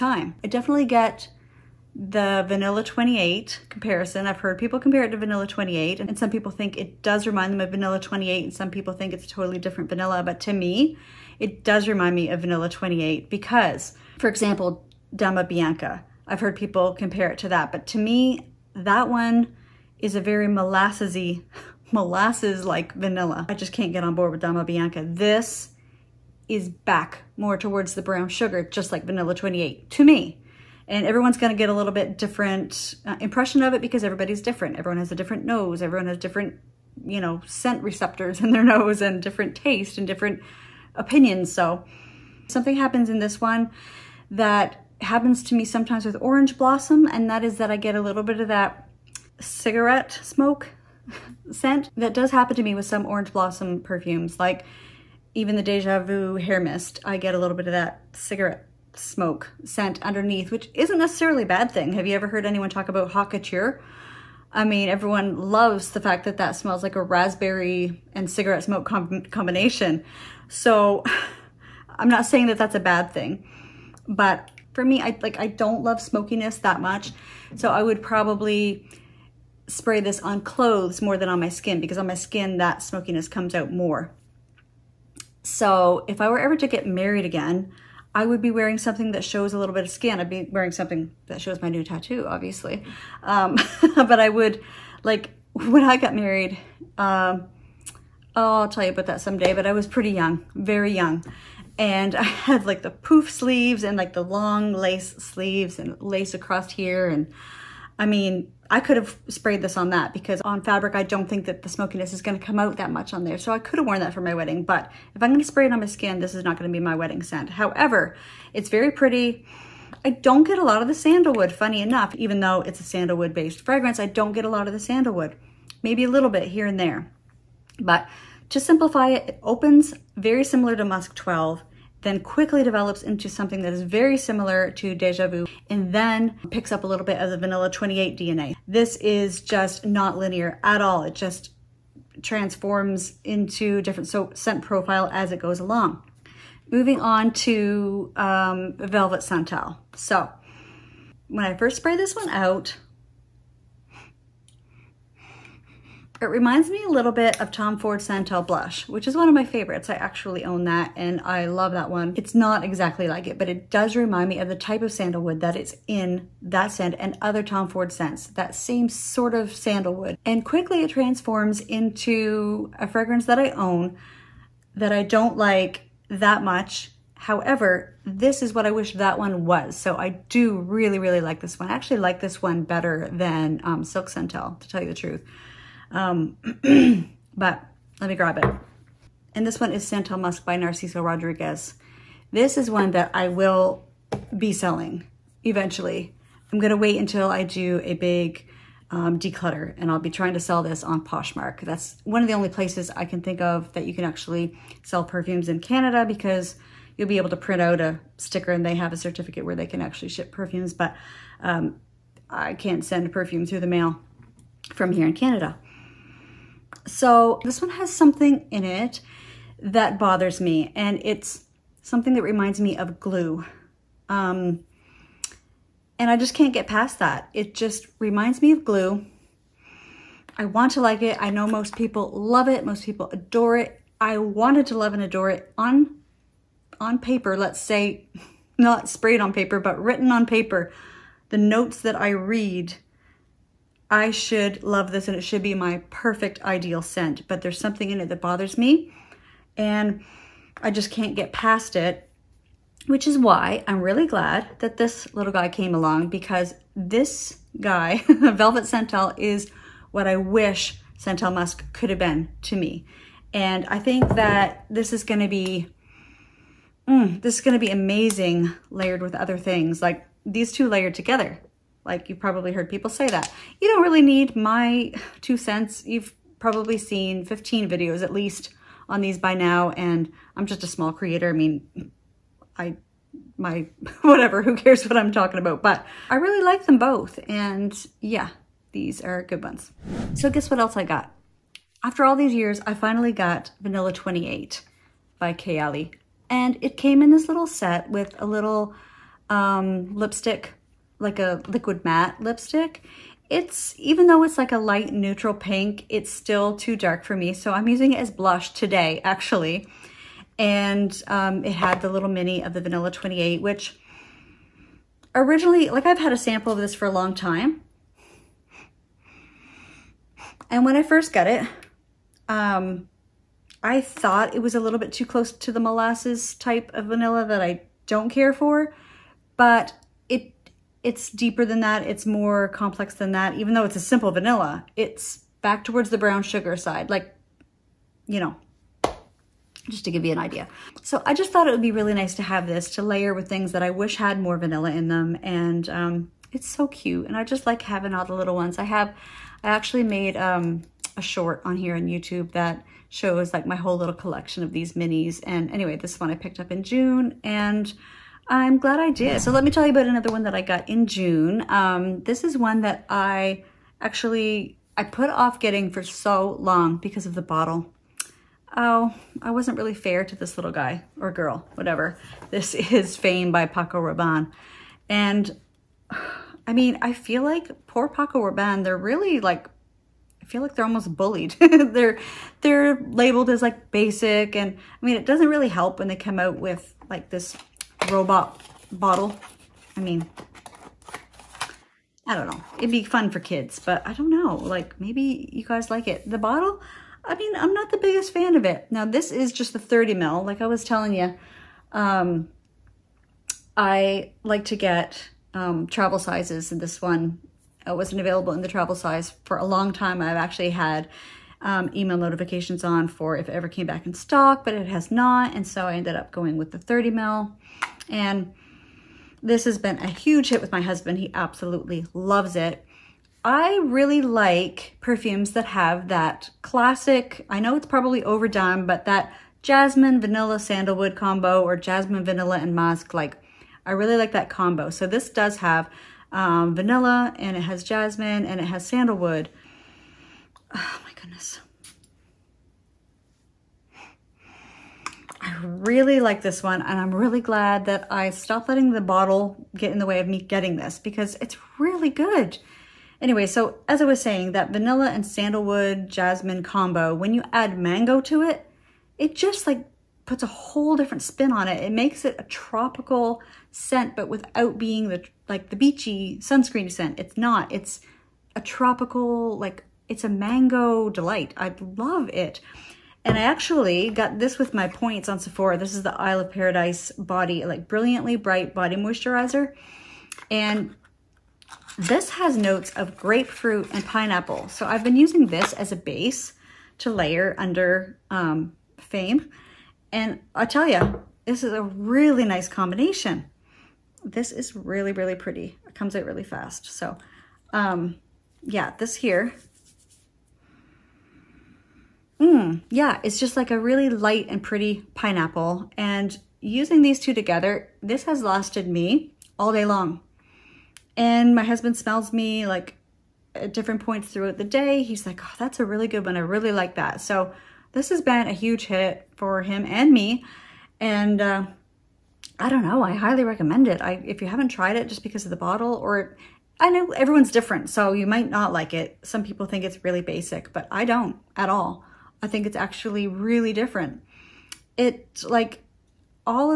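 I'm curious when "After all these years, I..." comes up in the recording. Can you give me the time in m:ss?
4:51.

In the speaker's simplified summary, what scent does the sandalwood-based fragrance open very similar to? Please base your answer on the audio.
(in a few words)
Musk 12.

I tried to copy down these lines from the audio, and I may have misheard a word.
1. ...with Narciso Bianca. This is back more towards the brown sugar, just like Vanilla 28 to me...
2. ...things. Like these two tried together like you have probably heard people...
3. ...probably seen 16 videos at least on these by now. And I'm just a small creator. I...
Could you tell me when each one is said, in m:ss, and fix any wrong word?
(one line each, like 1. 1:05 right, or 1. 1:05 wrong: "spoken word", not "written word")
1. 0:24 wrong: "Dama", not "Narciso"
2. 4:29 wrong: "layered", not "tried"
3. 4:36 wrong: "15", not "16".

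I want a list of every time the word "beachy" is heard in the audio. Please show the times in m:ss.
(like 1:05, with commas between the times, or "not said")
7:45.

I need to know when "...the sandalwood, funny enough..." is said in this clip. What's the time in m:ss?
2:00.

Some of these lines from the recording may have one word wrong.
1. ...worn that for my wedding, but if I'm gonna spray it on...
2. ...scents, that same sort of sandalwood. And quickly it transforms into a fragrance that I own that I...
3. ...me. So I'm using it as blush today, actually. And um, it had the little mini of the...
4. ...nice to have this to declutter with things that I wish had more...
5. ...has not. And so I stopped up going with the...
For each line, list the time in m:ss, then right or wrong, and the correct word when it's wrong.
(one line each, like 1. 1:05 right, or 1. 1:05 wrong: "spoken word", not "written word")
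1. 1:53 right
2. 2:47 right
3. 5:07 right
4. 5:41 wrong: "layer", not "declutter"
5. 6:54 wrong: "ended", not "stopped".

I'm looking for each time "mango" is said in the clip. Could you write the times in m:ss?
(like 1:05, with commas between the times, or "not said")
7:37, 7:50.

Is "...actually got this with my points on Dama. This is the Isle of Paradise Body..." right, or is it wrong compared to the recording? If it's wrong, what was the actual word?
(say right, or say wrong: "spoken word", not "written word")
wrong: "Sephora", not "Dama".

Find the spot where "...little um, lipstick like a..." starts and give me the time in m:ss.
4:58.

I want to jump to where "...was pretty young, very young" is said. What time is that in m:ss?
1:39.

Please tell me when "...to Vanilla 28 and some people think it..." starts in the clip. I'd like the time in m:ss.
0:05.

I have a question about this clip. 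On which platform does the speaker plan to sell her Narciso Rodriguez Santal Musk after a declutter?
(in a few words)
Poshmark.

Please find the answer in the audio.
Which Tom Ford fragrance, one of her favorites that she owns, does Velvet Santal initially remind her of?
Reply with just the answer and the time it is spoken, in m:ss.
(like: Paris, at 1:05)
Santal Blush, at 2:37.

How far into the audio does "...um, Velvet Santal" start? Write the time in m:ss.
2:28.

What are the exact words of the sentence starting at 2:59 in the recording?
So I do really, really like this one.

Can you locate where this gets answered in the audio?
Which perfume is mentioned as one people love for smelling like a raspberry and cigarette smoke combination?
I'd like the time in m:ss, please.
1:03.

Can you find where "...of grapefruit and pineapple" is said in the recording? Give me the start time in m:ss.
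8:02.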